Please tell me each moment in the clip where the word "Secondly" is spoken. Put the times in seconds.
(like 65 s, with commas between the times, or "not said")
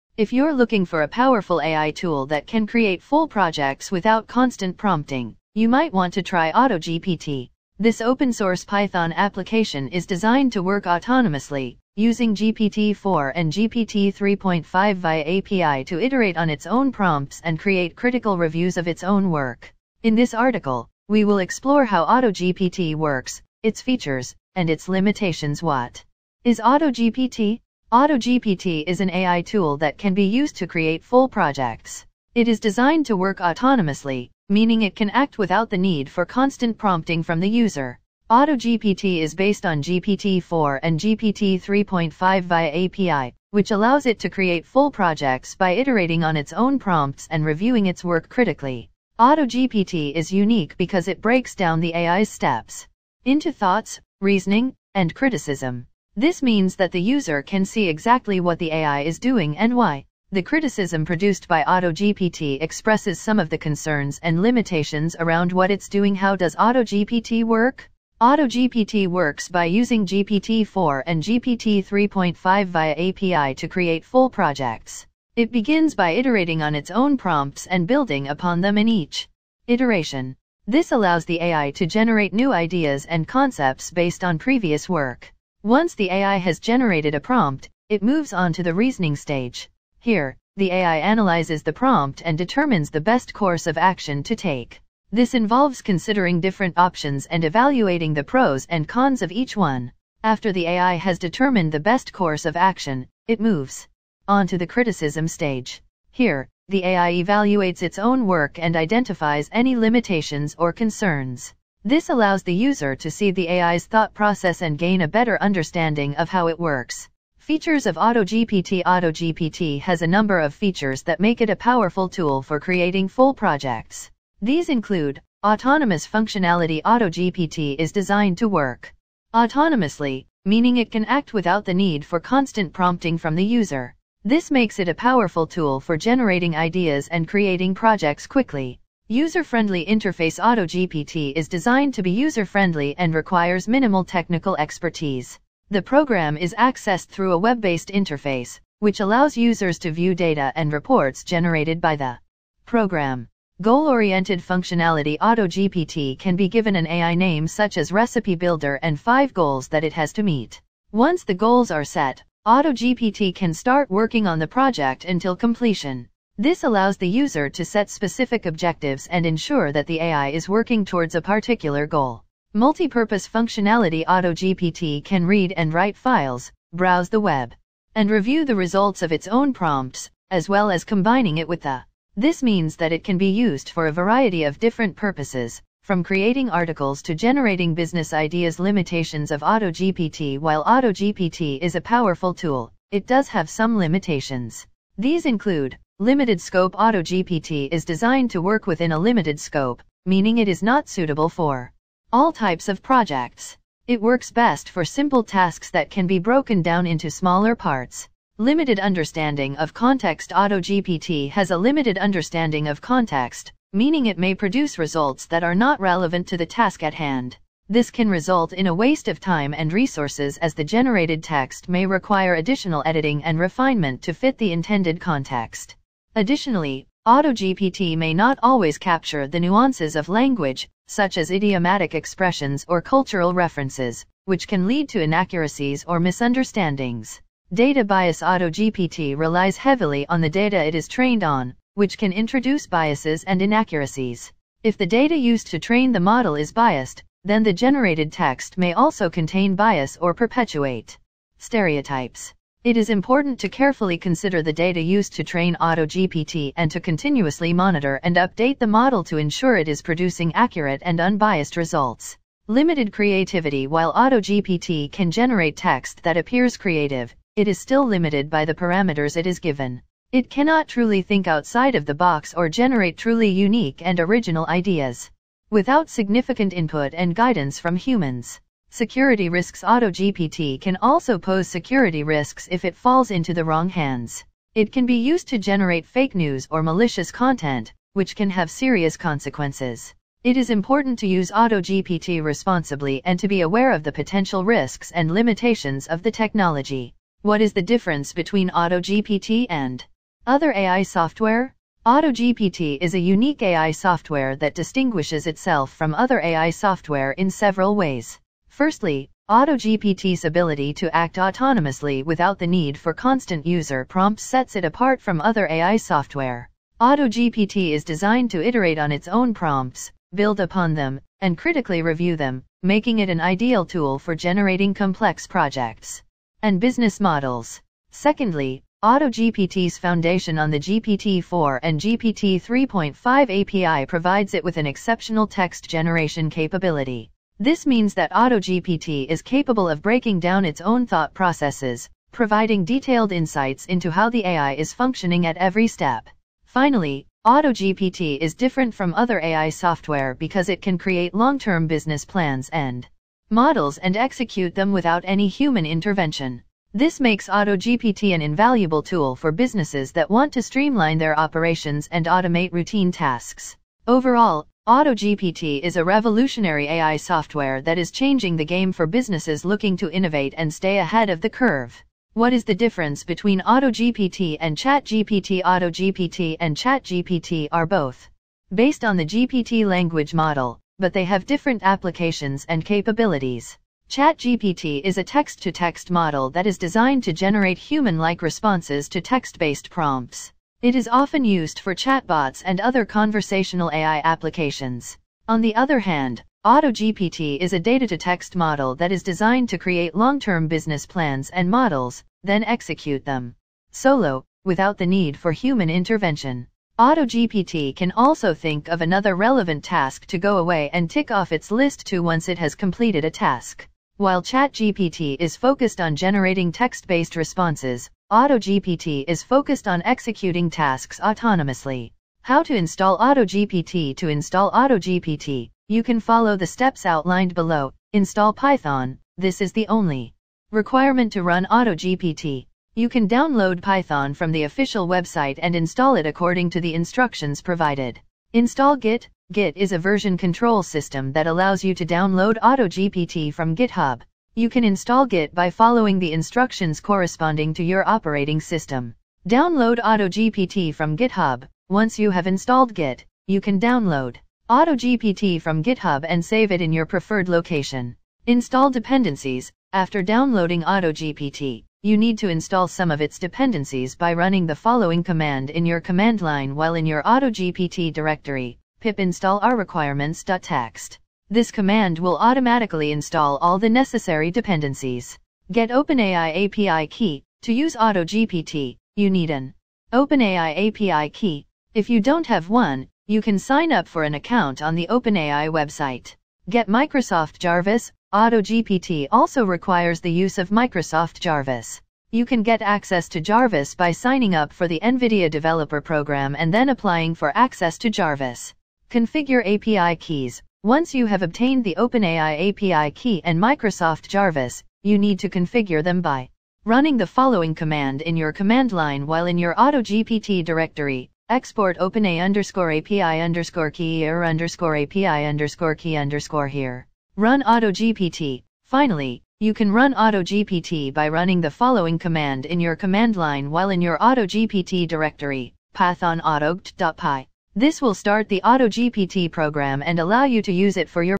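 327 s.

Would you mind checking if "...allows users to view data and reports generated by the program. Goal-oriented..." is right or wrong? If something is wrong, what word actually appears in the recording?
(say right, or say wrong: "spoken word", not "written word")
right.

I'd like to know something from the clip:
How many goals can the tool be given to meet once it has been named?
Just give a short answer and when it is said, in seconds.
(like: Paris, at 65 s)
5, at 158 s.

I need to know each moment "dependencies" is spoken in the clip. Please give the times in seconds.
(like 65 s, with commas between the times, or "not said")
458 s, 463 s, 474 s.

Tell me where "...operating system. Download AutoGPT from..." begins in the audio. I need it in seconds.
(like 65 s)
447 s.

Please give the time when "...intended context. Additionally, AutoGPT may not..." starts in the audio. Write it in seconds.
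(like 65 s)
224 s.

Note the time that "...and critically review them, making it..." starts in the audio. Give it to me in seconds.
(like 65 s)
321 s.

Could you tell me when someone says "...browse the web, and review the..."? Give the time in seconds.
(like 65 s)
176 s.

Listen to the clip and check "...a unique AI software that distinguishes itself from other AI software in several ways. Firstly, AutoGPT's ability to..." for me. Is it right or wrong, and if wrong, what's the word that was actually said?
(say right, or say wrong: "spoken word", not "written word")
right.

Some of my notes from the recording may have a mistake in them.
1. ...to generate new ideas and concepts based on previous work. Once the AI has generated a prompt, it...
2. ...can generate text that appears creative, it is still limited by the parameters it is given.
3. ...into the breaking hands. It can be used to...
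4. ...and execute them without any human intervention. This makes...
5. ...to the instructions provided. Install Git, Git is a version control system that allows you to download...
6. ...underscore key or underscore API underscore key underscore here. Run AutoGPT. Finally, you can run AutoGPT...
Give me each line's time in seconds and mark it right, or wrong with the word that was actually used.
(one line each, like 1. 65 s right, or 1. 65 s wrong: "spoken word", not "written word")
1. 81 s right
2. 264 s right
3. 283 s wrong: "wrong", not "breaking"
4. 353 s right
5. 436 s right
6. 513 s right.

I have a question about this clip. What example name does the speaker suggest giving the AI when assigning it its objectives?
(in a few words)
Recipe Builder.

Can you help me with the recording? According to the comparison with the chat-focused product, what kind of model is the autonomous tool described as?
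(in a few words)
Data-to-text model.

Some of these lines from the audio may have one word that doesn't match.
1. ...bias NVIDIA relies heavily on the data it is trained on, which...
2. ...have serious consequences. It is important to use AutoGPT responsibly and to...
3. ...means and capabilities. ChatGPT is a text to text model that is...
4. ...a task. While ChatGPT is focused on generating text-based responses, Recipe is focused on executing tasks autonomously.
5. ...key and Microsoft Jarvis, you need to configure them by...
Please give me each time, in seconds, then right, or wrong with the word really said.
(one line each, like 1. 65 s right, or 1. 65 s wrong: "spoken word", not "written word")
1. 237 s wrong: "AutoGPT", not "NVIDIA"
2. 288 s right
3. 381 s wrong: "applications", not "means"
4. 413 s wrong: "AutoGPT", not "Recipe"
5. 502 s right.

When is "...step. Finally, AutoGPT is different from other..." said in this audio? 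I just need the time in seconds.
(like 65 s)
345 s.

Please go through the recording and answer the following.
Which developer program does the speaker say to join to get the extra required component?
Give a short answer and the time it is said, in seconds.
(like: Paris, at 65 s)
NVIDIA Developer Program, at 494 s.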